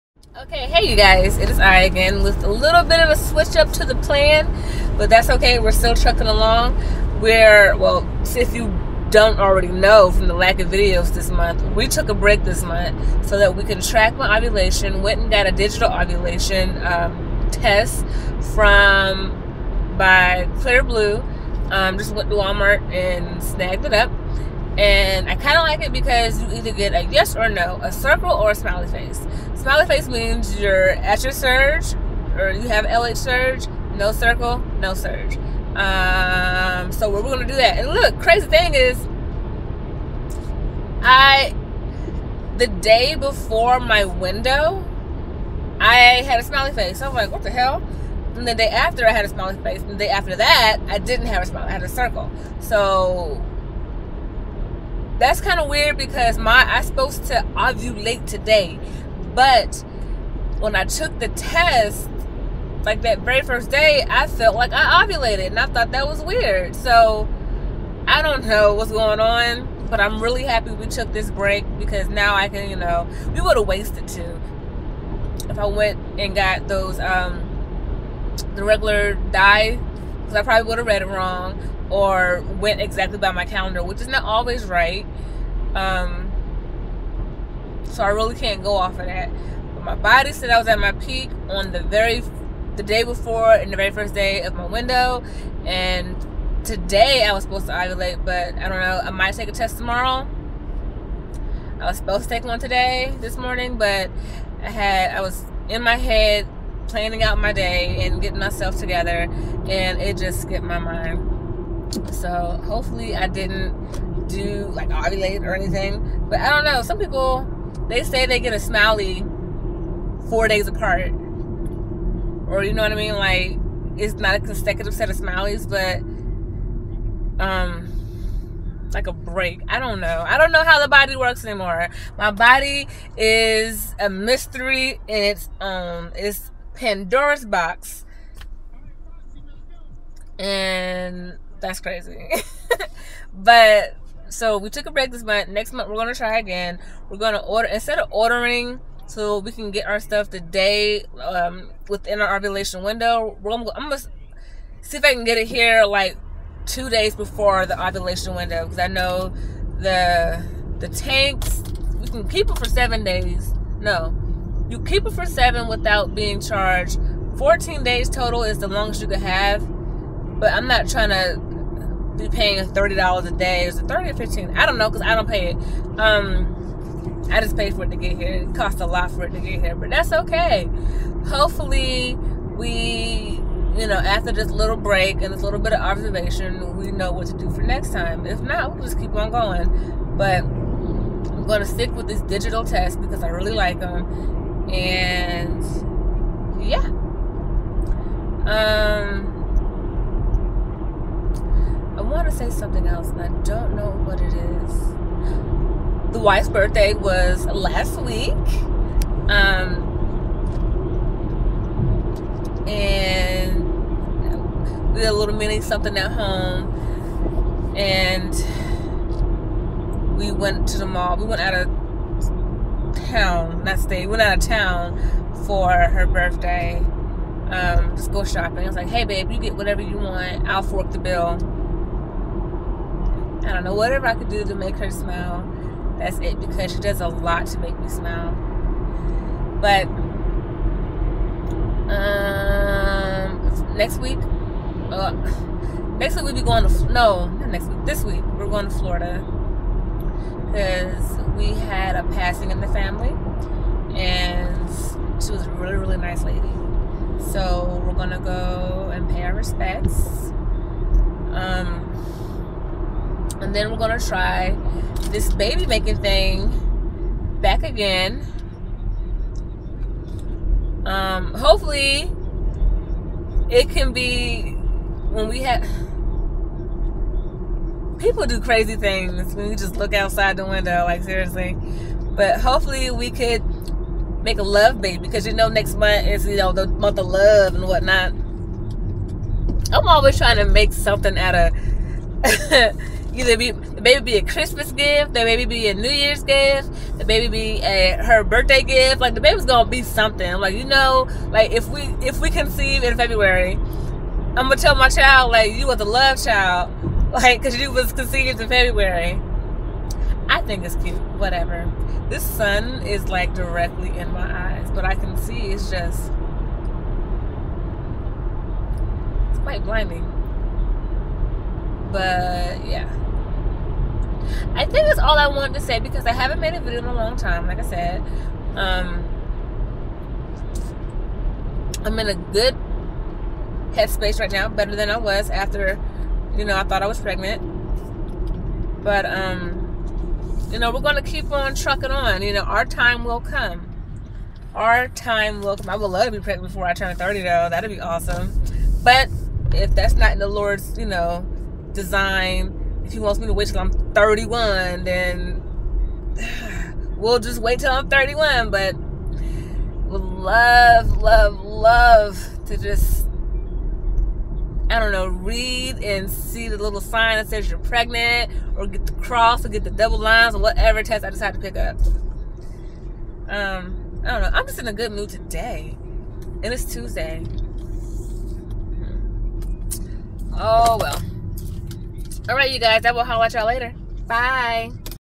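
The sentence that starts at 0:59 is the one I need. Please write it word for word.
But when I took the test, like that very first day, I felt like I ovulated and I thought that was weird.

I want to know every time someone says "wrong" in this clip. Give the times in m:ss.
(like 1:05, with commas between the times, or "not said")
1:21.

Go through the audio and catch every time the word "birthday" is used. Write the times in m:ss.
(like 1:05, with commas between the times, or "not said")
3:26, 3:46, 4:58.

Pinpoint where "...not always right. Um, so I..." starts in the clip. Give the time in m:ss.
1:24.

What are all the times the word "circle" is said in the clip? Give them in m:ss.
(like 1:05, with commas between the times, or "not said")
0:27, 0:34, 0:51.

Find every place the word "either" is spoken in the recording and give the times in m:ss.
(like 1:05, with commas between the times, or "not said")
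0:26, 4:53.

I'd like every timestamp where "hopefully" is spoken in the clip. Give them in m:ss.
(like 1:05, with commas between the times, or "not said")
1:52, 3:01, 4:31, 4:42.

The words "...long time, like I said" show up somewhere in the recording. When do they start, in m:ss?
5:26.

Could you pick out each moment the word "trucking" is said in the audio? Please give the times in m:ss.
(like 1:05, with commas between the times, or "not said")
0:05, 5:41.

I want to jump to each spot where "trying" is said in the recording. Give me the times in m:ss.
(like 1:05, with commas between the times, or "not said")
2:50, 4:50.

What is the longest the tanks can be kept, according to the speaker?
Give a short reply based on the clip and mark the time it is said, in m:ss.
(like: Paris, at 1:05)
14 days, at 2:47.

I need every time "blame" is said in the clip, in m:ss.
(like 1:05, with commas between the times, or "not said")
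not said.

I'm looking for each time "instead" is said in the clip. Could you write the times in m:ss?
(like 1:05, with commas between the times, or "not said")
2:27.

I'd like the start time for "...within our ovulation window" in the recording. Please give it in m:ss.
2:31.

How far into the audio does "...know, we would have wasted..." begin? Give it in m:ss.
1:12.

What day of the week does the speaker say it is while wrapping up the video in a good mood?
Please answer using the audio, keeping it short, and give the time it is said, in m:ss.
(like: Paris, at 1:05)
Tuesday, at 6:16.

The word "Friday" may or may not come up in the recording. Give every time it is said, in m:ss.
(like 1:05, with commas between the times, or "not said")
not said.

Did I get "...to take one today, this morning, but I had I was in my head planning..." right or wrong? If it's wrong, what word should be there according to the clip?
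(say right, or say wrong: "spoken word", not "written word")
right.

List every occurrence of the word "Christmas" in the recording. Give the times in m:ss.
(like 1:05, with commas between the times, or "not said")
4:54.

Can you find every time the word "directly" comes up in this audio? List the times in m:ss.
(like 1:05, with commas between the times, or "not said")
5:13.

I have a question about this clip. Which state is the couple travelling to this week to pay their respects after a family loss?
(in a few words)
Florida.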